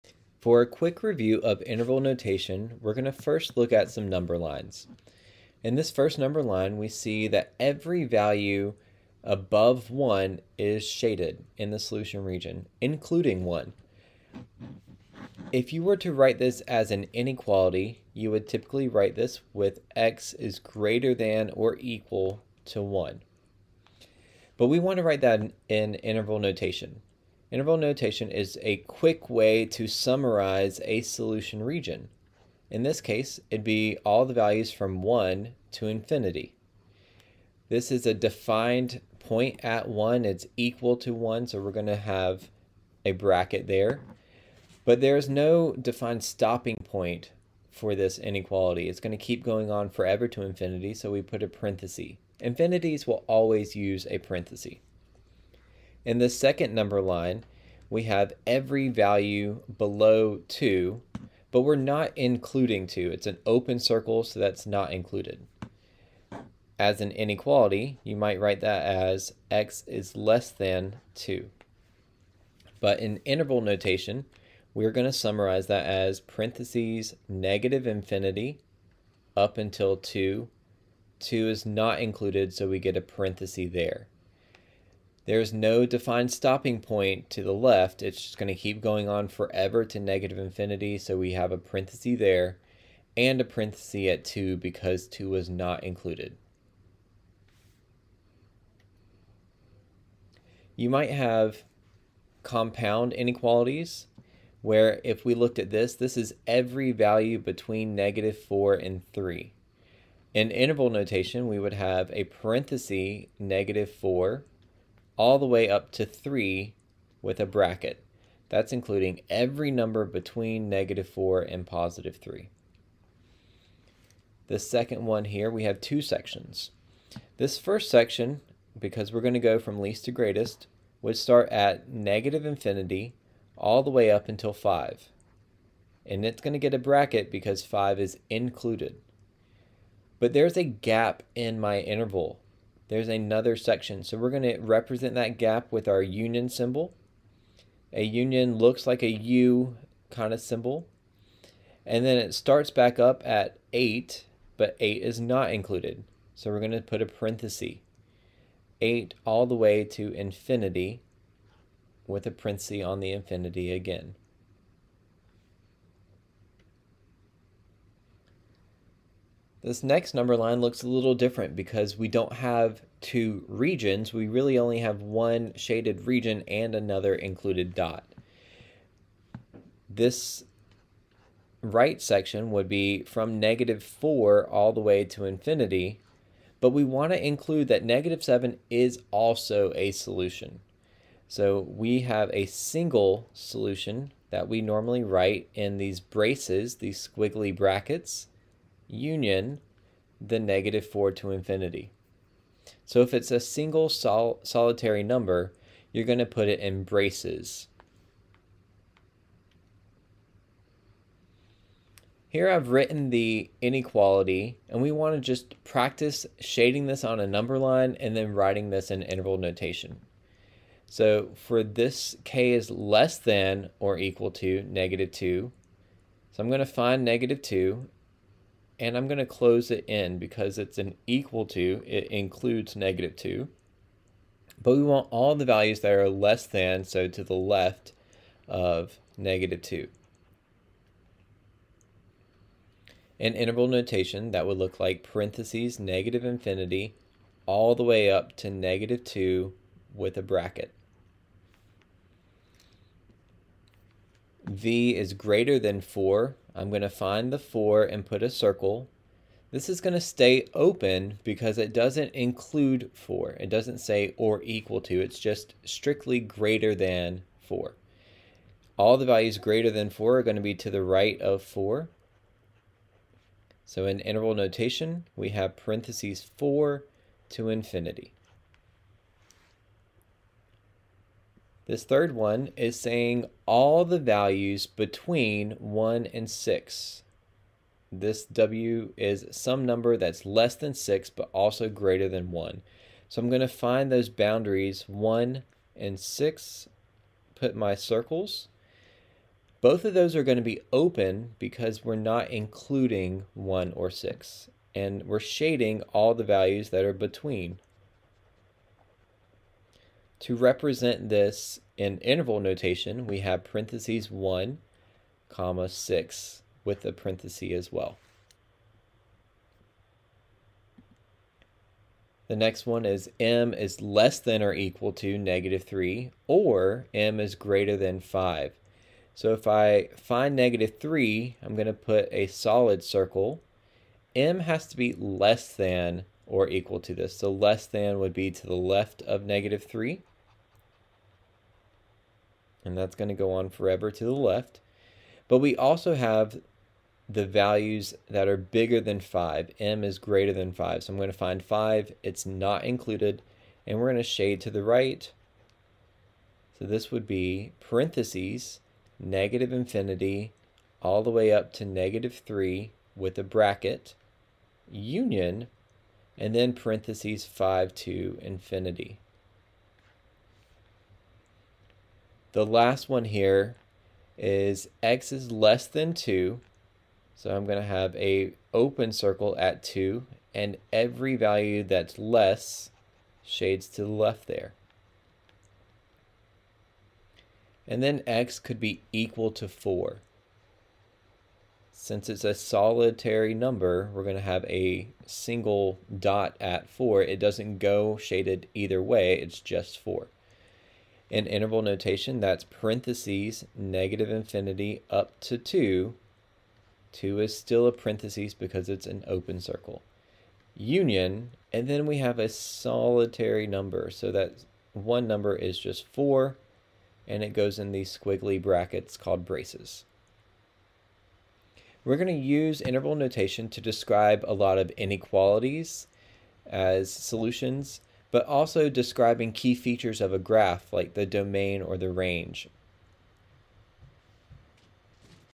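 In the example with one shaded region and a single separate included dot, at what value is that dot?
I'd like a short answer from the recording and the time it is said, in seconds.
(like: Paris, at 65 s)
-7, at 187 s.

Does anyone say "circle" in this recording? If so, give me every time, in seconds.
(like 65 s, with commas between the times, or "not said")
63 s, 258 s, 297 s, 332 s, 378 s, 409 s.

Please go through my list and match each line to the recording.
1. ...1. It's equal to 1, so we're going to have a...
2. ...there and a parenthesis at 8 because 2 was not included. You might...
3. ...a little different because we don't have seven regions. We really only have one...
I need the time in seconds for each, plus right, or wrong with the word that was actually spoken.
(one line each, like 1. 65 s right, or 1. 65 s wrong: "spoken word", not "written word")
1. 39 s right
2. 92 s wrong: "2", not "8"
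3. 170 s wrong: "two", not "seven".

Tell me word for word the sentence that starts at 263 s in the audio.
It doesn't say or equal to.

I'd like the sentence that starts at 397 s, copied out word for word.
It doesn't go shaded either way, it's just 4 in interval notation, that's parentheses, negative infinity up to 2.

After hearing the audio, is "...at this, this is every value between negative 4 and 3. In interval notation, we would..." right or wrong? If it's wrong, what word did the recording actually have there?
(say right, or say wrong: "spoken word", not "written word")
right.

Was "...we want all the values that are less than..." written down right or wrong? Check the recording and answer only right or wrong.
right.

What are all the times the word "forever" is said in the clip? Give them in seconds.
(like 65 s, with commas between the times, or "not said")
49 s, 89 s, 343 s.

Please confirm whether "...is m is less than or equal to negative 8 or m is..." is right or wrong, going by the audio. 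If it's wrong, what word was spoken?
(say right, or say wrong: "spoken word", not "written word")
wrong: "3", not "8".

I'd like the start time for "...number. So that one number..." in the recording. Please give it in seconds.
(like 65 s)
413 s.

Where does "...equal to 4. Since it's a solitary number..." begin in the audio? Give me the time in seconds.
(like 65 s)
388 s.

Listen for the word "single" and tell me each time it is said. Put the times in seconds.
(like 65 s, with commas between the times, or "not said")
192 s, 203 s, 395 s.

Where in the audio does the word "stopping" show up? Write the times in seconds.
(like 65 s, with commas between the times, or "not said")
46 s, 86 s.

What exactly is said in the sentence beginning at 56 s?
In the second number line, we have every value below 2, but we're not including 2.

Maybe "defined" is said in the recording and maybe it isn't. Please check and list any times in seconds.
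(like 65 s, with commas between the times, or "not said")
38 s, 45 s, 85 s.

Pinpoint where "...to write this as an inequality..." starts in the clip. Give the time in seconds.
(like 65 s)
15 s.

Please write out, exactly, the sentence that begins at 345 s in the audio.
But we also have the values that are bigger than 5.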